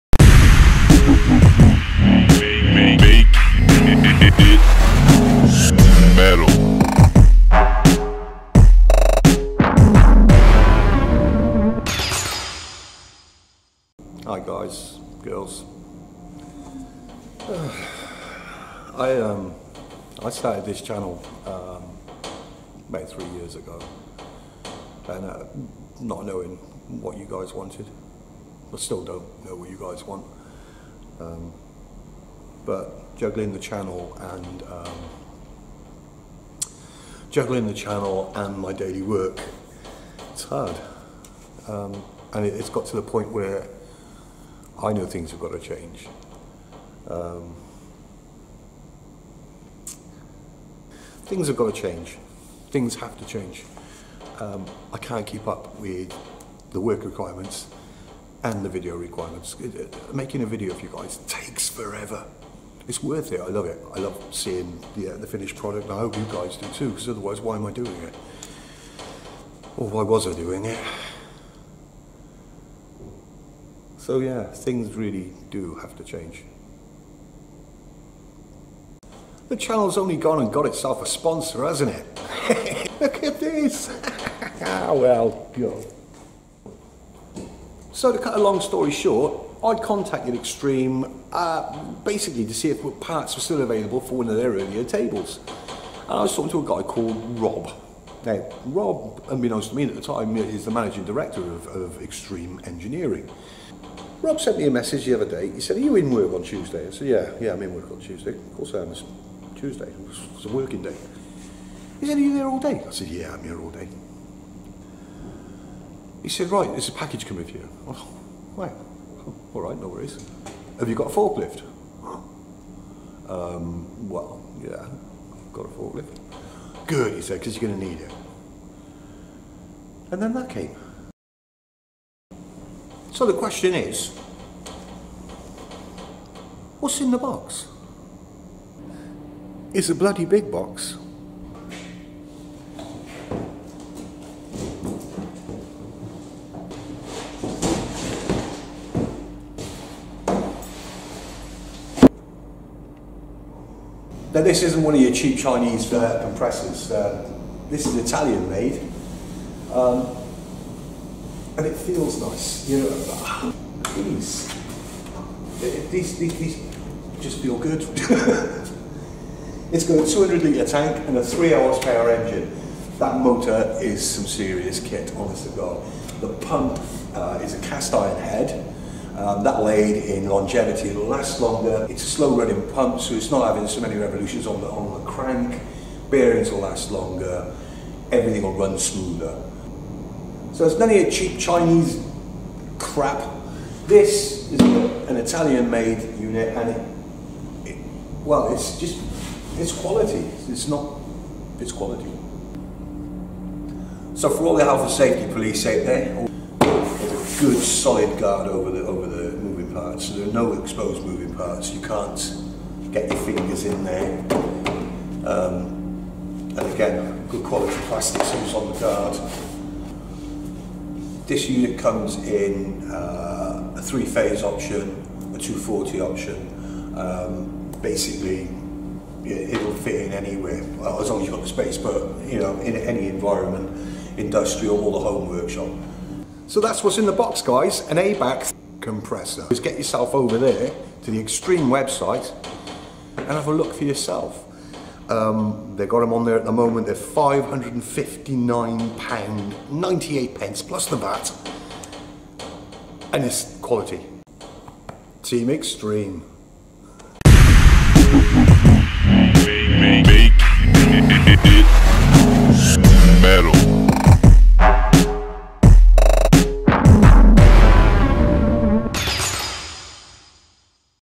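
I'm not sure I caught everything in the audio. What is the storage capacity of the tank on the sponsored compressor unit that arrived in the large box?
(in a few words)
200 litres.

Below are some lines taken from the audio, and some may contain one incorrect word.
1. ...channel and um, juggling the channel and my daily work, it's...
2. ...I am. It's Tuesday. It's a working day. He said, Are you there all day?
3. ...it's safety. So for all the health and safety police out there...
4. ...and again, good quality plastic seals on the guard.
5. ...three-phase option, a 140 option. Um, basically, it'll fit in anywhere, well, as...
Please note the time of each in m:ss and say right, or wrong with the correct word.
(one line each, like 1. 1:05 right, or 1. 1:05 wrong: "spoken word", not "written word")
1. 0:33 right
2. 1:48 right
3. 3:21 wrong: "quality", not "safety"
4. 3:36 right
5. 3:43 wrong: "240", not "140".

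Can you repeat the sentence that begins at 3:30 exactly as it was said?
So there are no exposed moving parts.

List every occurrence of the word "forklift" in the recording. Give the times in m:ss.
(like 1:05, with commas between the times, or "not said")
2:01, 2:05.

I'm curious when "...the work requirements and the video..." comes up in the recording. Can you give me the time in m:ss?
0:56.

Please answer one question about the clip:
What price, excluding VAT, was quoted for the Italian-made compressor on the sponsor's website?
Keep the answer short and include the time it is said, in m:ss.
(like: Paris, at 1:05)
£559.98, at 4:06.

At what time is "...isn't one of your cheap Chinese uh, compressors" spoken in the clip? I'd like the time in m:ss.
2:34.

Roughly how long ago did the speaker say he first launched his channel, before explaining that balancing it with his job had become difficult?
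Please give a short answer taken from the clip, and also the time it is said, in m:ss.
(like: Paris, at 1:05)
3 years, at 0:23.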